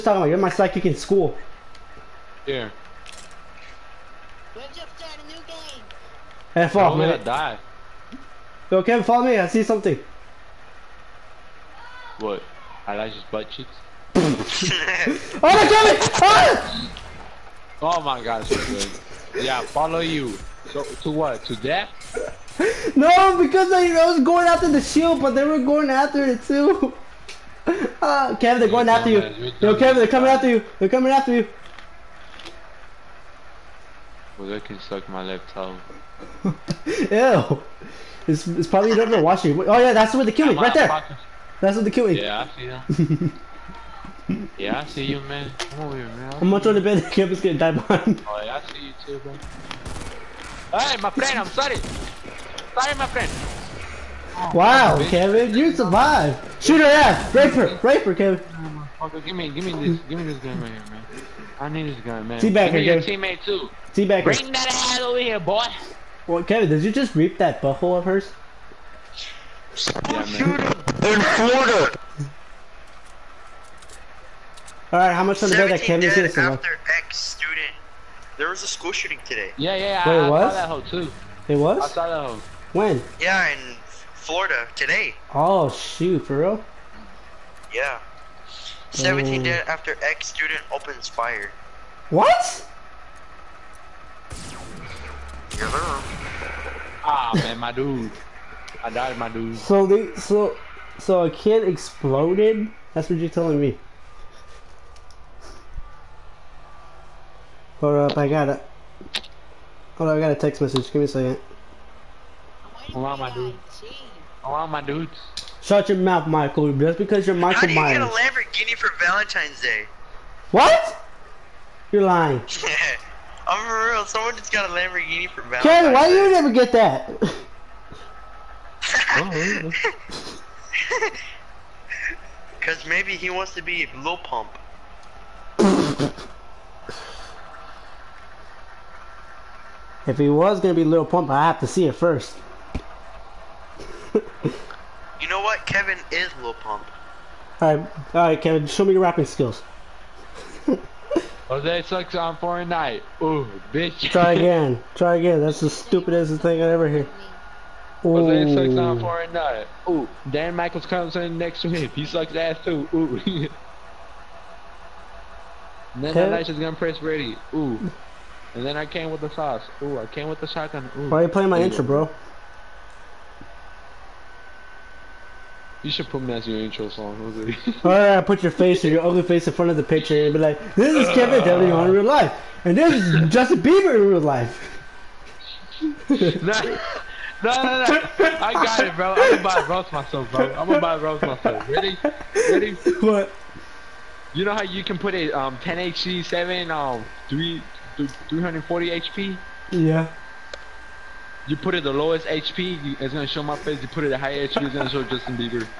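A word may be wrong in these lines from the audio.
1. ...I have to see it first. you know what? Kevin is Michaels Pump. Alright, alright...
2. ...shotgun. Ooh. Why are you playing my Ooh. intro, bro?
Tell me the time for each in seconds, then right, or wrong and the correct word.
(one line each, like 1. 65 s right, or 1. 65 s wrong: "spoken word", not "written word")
1. 141 s wrong: "Lil", not "Michaels"
2. 170 s right.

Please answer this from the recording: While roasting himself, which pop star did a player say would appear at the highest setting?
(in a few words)
Justin Bieber.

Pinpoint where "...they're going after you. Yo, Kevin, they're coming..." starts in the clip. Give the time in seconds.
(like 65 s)
28 s.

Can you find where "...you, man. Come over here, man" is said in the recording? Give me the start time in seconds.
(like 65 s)
45 s.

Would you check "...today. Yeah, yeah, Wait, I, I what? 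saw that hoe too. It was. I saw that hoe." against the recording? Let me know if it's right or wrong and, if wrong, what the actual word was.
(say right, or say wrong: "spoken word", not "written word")
right.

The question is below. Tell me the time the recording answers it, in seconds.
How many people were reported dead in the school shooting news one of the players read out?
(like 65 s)
88 s.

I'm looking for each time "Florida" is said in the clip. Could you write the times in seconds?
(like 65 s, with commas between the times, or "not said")
71 s, 84 s.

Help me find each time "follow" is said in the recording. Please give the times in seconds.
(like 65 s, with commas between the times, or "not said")
9 s, 19 s.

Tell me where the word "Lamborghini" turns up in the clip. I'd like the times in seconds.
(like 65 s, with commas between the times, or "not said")
118 s, 124 s.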